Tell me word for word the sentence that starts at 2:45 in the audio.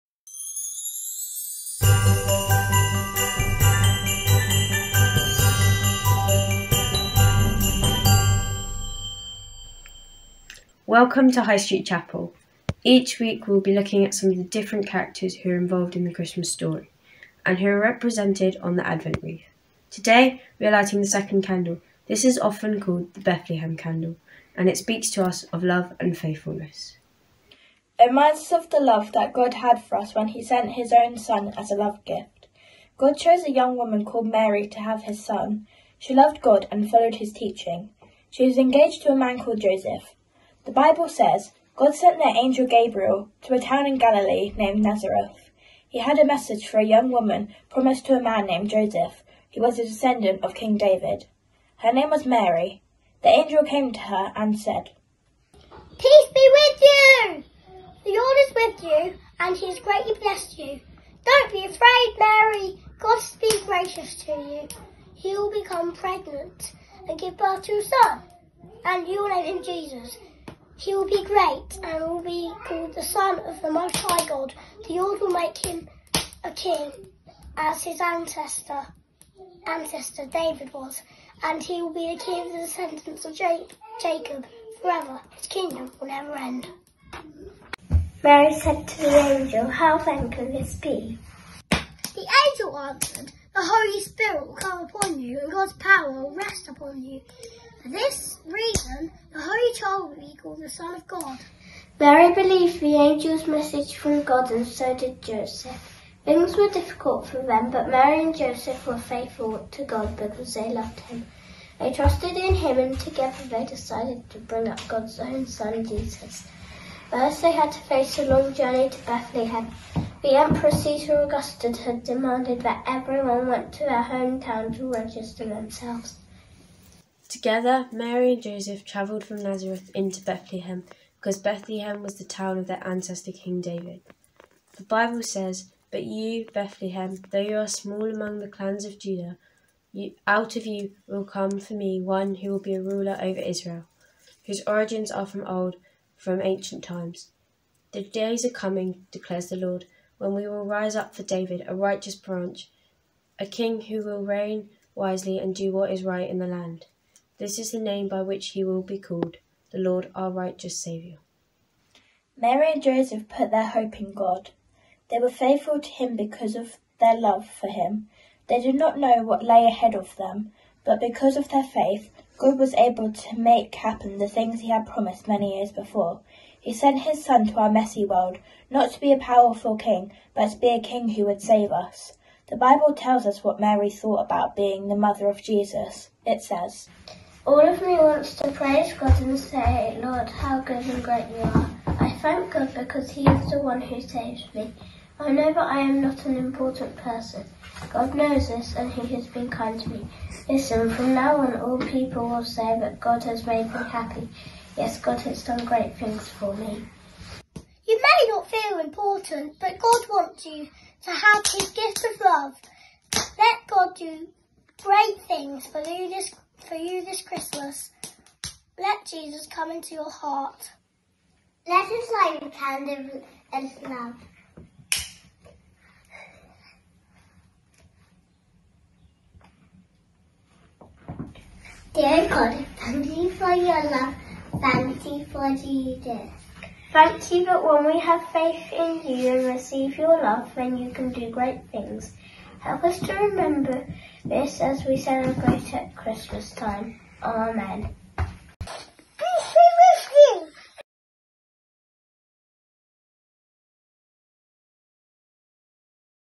They were faithful to him because of their love for him.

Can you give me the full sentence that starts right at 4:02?
Help us to remember this as we celebrate at Christmas time.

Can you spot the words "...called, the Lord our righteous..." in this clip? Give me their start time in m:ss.
2:38.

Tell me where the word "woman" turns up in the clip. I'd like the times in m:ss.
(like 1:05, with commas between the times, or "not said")
0:33, 0:47.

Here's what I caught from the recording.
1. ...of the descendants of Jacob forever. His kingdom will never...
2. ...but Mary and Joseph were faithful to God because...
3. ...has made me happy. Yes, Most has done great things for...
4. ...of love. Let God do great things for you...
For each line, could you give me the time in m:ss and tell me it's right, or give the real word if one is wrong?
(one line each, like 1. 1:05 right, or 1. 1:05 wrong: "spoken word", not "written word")
1. 1:22 right
2. 1:47 right
3. 3:23 wrong: "God", not "Most"
4. 3:32 right.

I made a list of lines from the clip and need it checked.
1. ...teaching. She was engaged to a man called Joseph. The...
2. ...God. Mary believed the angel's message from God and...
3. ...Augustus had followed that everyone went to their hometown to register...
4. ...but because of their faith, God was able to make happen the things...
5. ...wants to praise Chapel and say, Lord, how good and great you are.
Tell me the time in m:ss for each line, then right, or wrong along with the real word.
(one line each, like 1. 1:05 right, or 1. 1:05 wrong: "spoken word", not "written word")
1. 0:37 right
2. 1:41 right
3. 2:01 wrong: "demanded", not "followed"
4. 2:50 right
5. 3:07 wrong: "God", not "Chapel".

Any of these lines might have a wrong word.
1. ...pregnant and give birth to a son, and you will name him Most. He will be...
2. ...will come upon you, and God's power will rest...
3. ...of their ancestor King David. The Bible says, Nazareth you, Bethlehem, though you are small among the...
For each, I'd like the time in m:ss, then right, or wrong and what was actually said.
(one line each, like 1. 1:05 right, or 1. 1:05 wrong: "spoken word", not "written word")
1. 1:05 wrong: "Jesus", not "Most"
2. 1:34 right
3. 2:12 wrong: "But", not "Nazareth".